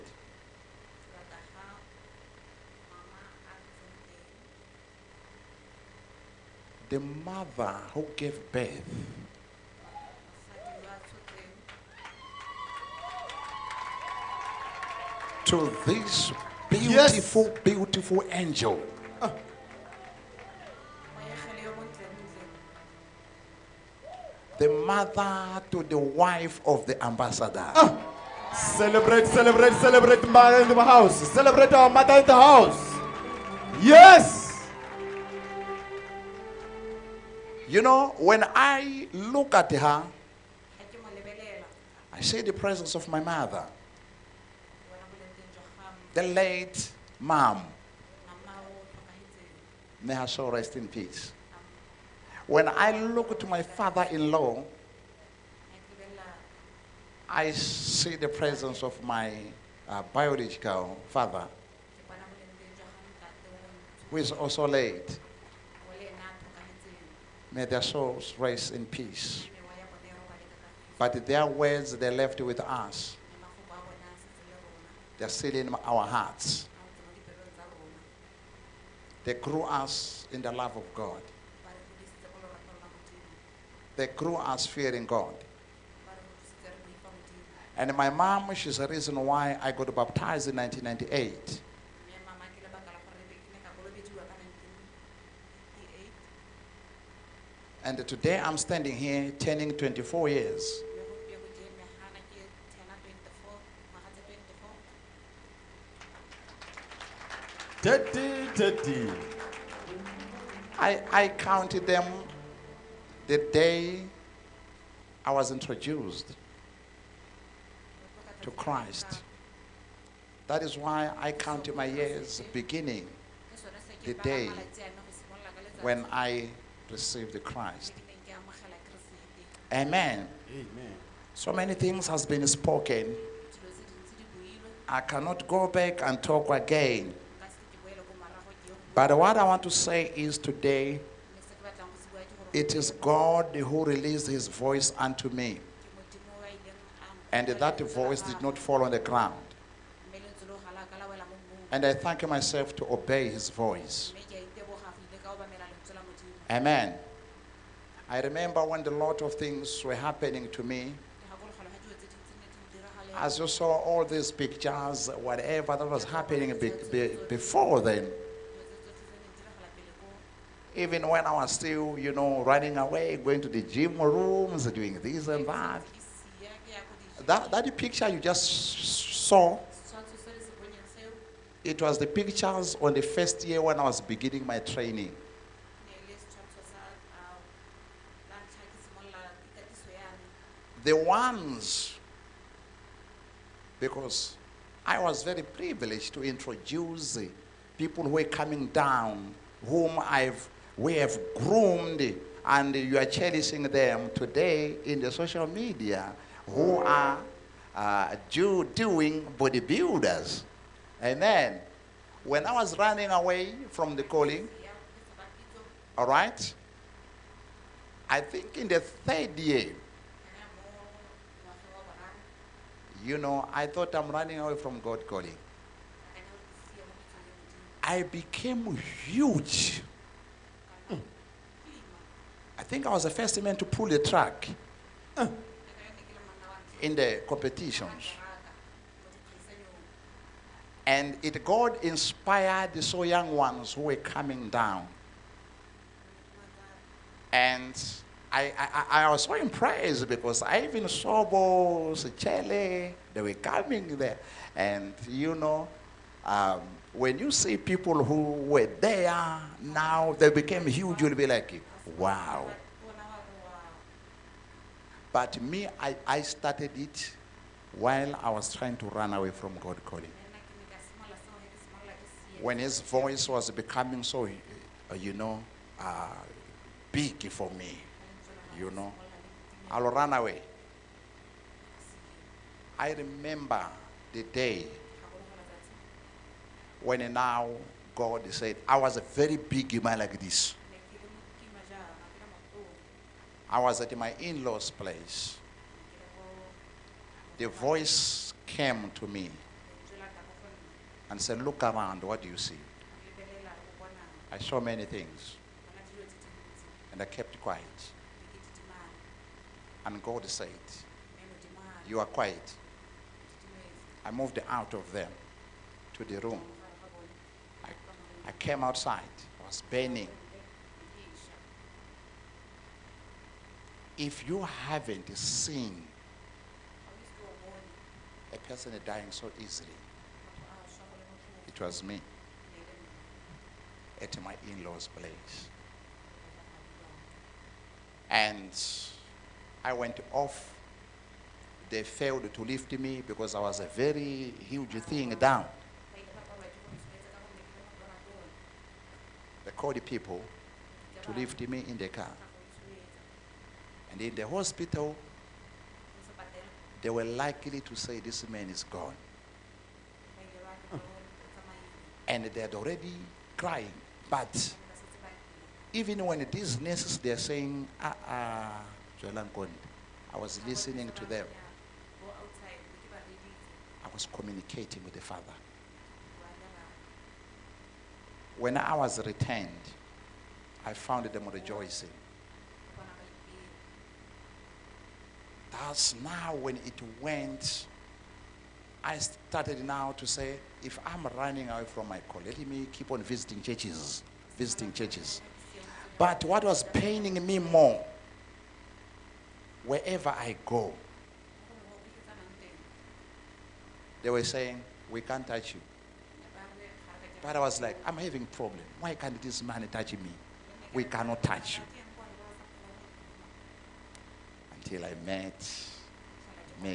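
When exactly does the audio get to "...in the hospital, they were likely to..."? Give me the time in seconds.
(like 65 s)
354 s.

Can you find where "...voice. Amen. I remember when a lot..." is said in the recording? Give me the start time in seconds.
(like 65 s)
153 s.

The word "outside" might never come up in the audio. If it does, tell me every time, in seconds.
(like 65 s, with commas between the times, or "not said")
318 s.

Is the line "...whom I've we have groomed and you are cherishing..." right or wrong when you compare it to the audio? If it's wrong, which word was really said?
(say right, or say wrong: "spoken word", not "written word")
right.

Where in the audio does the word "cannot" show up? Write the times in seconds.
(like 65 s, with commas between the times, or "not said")
135 s, 410 s.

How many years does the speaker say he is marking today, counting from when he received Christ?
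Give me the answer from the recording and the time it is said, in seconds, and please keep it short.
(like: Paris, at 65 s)
24, at 99 s.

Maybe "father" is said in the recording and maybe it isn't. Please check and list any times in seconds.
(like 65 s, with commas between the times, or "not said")
53 s, 61 s, 375 s.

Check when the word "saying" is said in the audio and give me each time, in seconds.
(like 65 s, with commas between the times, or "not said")
367 s, 404 s.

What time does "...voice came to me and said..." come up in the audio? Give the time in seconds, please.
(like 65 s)
297 s.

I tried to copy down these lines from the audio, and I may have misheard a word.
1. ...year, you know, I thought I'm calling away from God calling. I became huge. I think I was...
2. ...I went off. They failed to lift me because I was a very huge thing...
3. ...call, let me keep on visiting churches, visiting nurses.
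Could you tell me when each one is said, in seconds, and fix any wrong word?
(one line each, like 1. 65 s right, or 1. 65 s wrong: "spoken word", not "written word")
1. 219 s wrong: "running", not "calling"
2. 339 s right
3. 392 s wrong: "churches", not "nurses".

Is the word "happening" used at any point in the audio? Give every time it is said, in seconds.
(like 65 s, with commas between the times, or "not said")
159 s, 166 s.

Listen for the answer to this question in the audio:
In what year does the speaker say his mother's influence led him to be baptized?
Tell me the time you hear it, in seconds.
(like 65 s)
90 s.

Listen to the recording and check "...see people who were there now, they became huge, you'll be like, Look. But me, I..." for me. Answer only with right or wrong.
wrong.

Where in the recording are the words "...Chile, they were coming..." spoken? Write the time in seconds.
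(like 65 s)
252 s.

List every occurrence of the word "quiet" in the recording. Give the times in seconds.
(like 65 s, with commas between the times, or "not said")
307 s, 312 s.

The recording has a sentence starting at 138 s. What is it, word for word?
But what I want to say is today it is God who released his voice unto me.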